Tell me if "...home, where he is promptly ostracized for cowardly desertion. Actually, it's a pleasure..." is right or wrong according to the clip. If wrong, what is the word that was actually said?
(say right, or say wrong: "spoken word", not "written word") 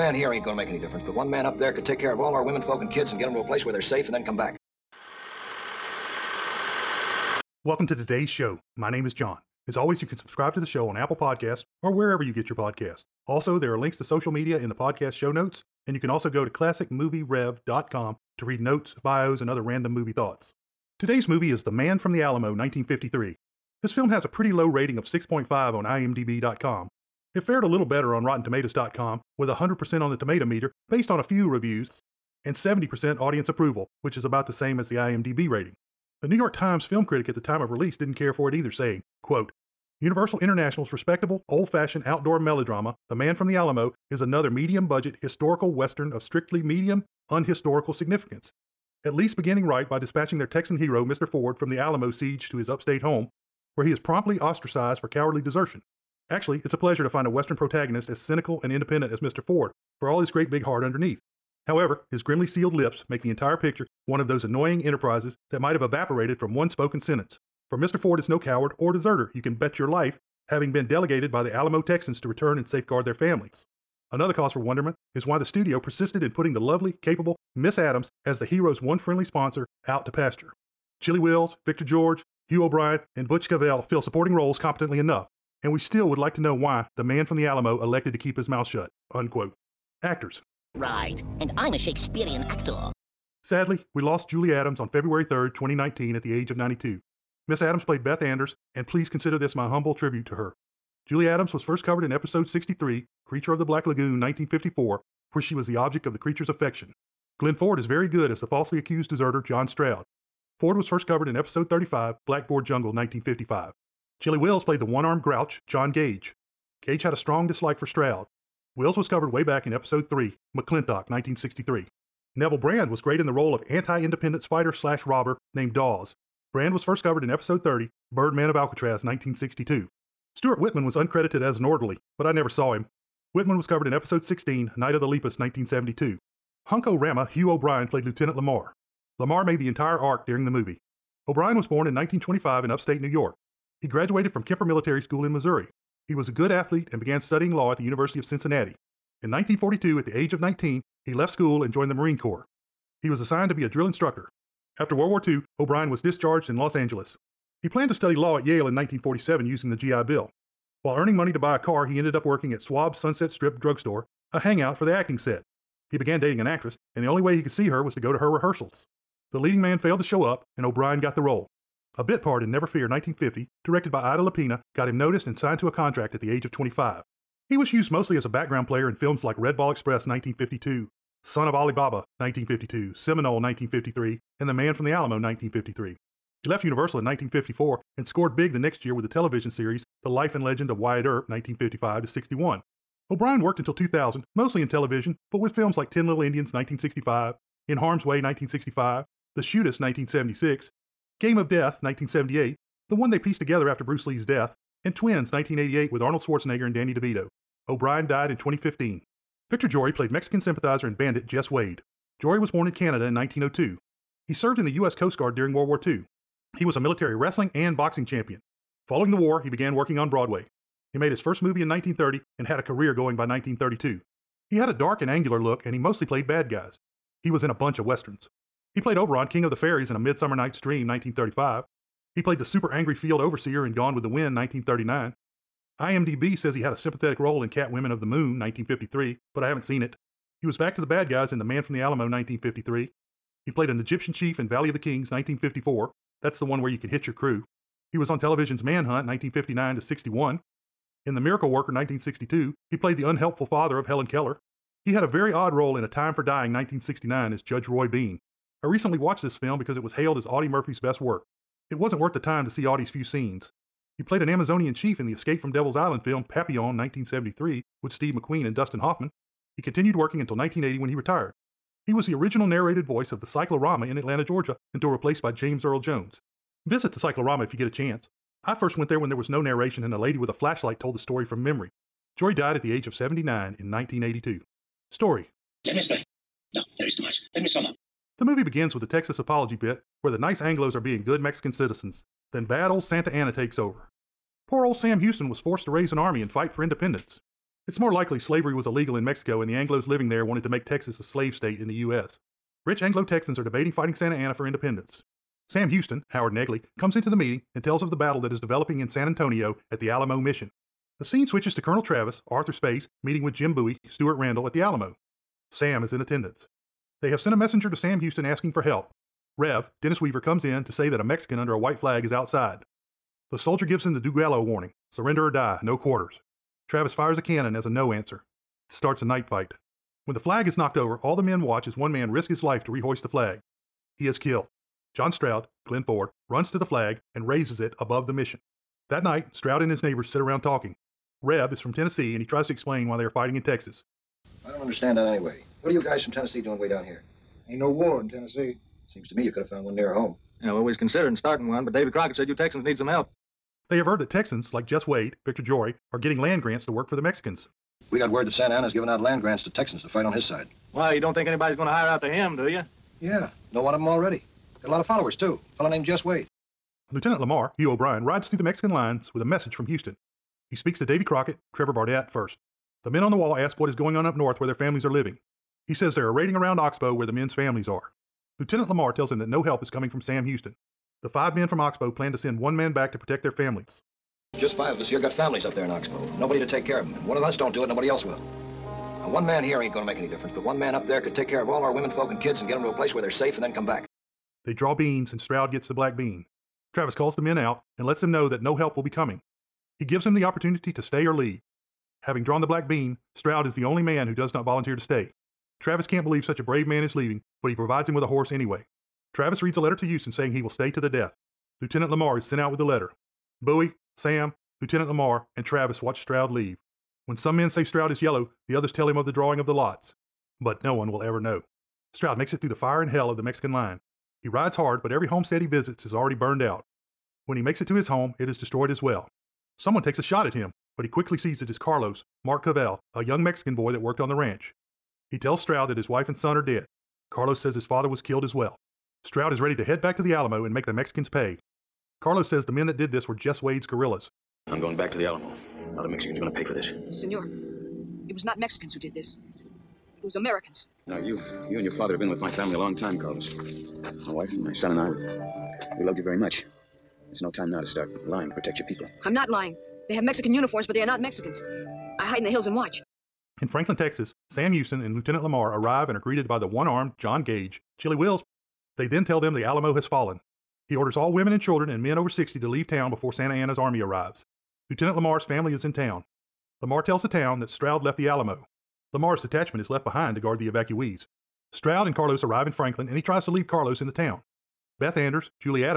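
right.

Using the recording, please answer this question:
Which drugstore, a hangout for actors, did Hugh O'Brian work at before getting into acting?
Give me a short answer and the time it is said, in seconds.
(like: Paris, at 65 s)
Schwab Sunset Strip Drugstore, at 162 s.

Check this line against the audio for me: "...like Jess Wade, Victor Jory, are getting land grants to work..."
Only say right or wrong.
right.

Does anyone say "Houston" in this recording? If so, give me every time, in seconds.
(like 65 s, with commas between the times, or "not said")
295 s, 305 s, 317 s, 369 s, 380 s, 409 s, 464 s.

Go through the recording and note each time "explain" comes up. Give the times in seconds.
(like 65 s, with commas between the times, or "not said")
285 s, 342 s.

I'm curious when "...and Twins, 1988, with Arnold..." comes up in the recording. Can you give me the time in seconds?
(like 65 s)
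204 s.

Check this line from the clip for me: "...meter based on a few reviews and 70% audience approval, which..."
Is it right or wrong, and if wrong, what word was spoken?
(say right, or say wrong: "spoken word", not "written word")
right.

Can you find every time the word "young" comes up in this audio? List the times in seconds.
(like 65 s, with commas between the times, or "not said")
433 s.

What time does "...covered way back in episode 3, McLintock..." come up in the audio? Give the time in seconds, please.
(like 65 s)
119 s.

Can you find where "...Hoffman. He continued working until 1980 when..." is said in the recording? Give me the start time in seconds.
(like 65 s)
268 s.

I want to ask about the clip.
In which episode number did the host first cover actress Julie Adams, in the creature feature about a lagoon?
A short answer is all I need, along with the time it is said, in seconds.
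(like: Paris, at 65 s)
63, at 102 s.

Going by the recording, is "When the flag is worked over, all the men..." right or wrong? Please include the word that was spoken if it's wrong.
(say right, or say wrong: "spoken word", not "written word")
wrong: "knocked", not "worked".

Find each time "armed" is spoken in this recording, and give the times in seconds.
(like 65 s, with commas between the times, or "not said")
115 s, 466 s.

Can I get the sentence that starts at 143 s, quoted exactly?
He graduated from Kemper Military School in Missouri.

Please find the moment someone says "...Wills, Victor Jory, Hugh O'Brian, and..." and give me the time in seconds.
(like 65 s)
81 s.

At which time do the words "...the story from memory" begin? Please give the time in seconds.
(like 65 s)
280 s.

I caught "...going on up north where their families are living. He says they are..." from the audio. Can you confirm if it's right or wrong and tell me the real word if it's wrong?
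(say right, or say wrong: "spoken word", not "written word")
right.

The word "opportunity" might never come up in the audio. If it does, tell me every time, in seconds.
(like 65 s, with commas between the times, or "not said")
400 s.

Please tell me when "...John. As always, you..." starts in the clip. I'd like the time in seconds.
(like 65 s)
9 s.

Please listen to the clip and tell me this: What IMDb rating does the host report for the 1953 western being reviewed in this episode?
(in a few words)
6.5.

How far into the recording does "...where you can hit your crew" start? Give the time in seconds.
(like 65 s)
246 s.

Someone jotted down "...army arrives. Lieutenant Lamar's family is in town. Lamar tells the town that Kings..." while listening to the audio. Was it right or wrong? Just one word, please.
wrong.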